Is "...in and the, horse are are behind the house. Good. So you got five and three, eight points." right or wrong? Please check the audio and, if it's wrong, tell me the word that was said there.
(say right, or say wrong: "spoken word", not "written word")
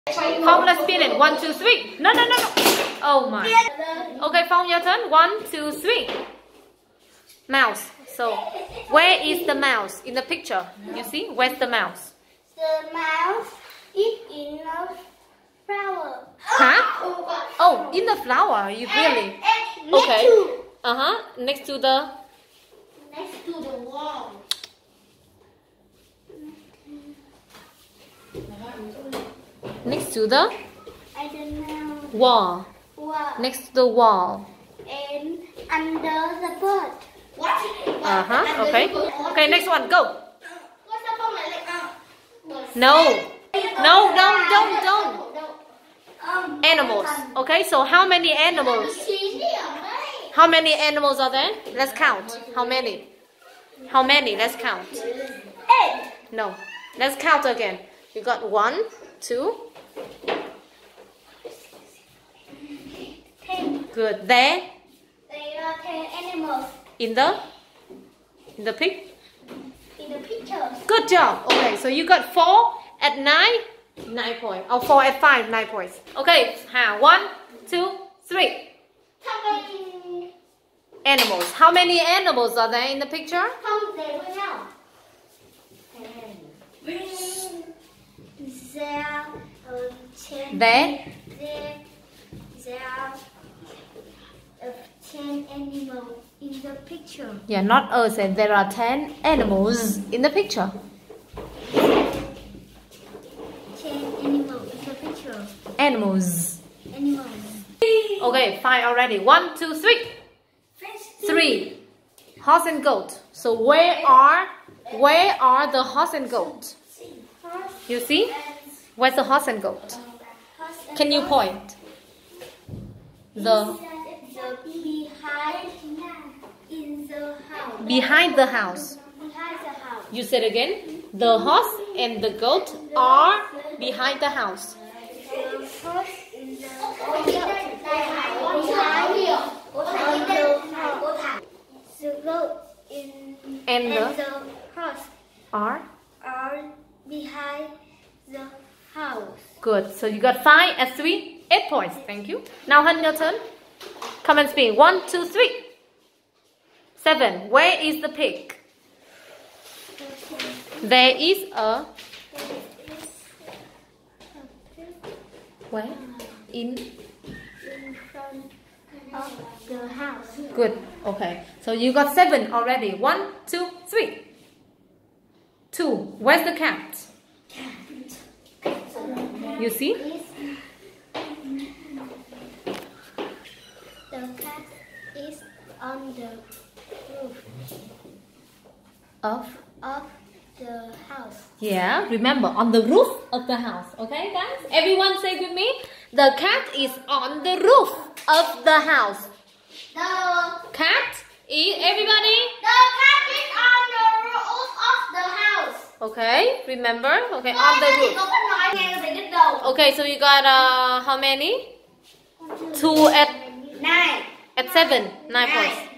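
right.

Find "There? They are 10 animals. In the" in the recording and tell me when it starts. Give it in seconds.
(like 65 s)
64 s.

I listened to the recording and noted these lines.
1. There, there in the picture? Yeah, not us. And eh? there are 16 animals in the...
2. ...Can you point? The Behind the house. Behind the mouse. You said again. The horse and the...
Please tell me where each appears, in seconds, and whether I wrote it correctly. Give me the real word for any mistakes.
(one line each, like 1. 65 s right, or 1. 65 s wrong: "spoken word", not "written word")
1. 88 s wrong: "10", not "16"
2. 120 s wrong: "house", not "mouse".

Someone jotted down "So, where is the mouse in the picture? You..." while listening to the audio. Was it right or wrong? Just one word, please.
right.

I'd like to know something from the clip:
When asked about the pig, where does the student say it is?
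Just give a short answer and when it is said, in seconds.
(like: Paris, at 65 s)
in front of the house, at 166 s.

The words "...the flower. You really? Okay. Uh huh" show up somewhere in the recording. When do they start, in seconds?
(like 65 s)
18 s.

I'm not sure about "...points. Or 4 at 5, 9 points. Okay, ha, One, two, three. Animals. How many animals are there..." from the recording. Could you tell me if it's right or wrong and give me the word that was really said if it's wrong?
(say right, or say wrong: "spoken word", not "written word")
right.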